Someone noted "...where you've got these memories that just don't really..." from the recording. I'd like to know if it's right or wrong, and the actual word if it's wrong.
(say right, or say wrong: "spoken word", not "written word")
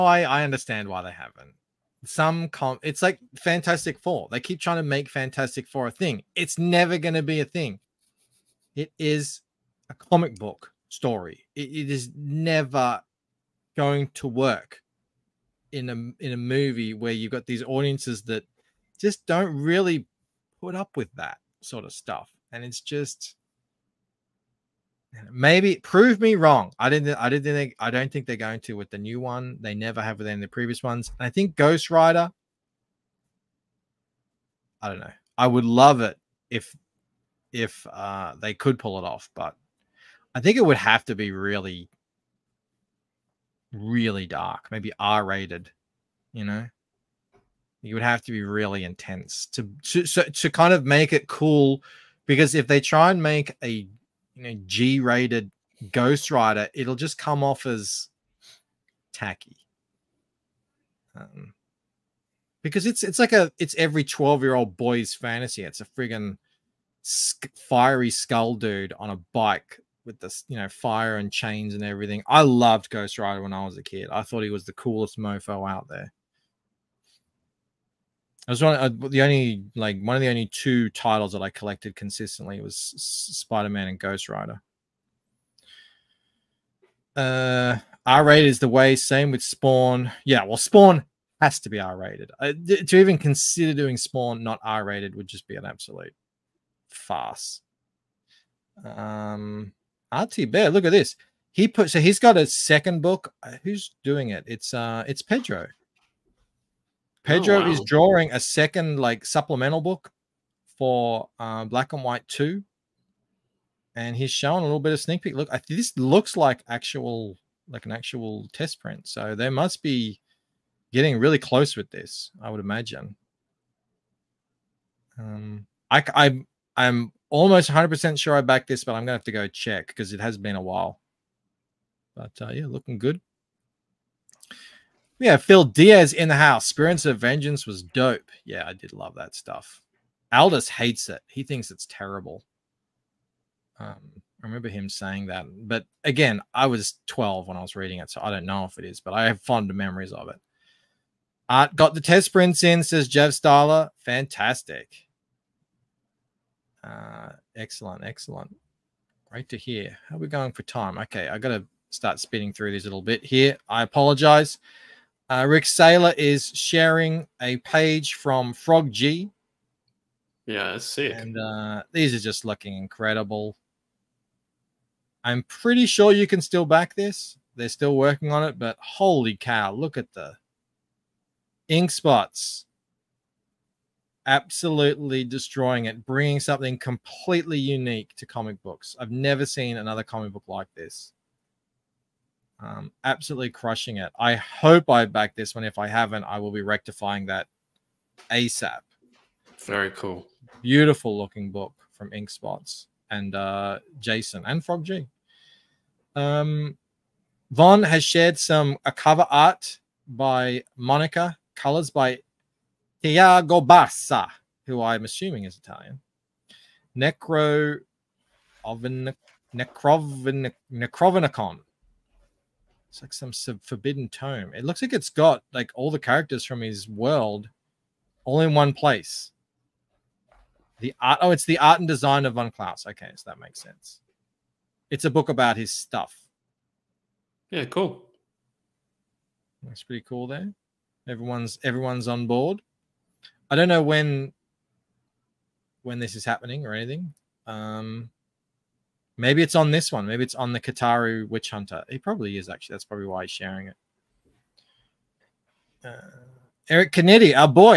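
wrong: "audiences", not "memories".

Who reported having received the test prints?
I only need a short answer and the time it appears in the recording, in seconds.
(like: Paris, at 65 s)
Jeff Styler, at 152 s.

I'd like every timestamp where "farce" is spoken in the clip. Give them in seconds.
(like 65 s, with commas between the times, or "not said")
96 s.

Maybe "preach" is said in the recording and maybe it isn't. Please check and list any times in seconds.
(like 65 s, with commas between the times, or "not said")
not said.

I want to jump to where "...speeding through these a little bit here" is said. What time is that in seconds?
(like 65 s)
162 s.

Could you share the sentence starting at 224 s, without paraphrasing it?
It looks like it's got like all the characters from his world all in one place.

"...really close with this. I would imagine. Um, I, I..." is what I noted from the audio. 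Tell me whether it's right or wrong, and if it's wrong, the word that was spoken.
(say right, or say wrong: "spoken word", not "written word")
right.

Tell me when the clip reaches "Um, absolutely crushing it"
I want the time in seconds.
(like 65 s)
192 s.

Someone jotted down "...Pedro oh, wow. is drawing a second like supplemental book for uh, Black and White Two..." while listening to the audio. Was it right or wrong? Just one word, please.
right.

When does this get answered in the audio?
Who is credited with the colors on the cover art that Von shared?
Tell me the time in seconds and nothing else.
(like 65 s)
213 s.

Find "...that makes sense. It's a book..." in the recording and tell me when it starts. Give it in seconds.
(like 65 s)
233 s.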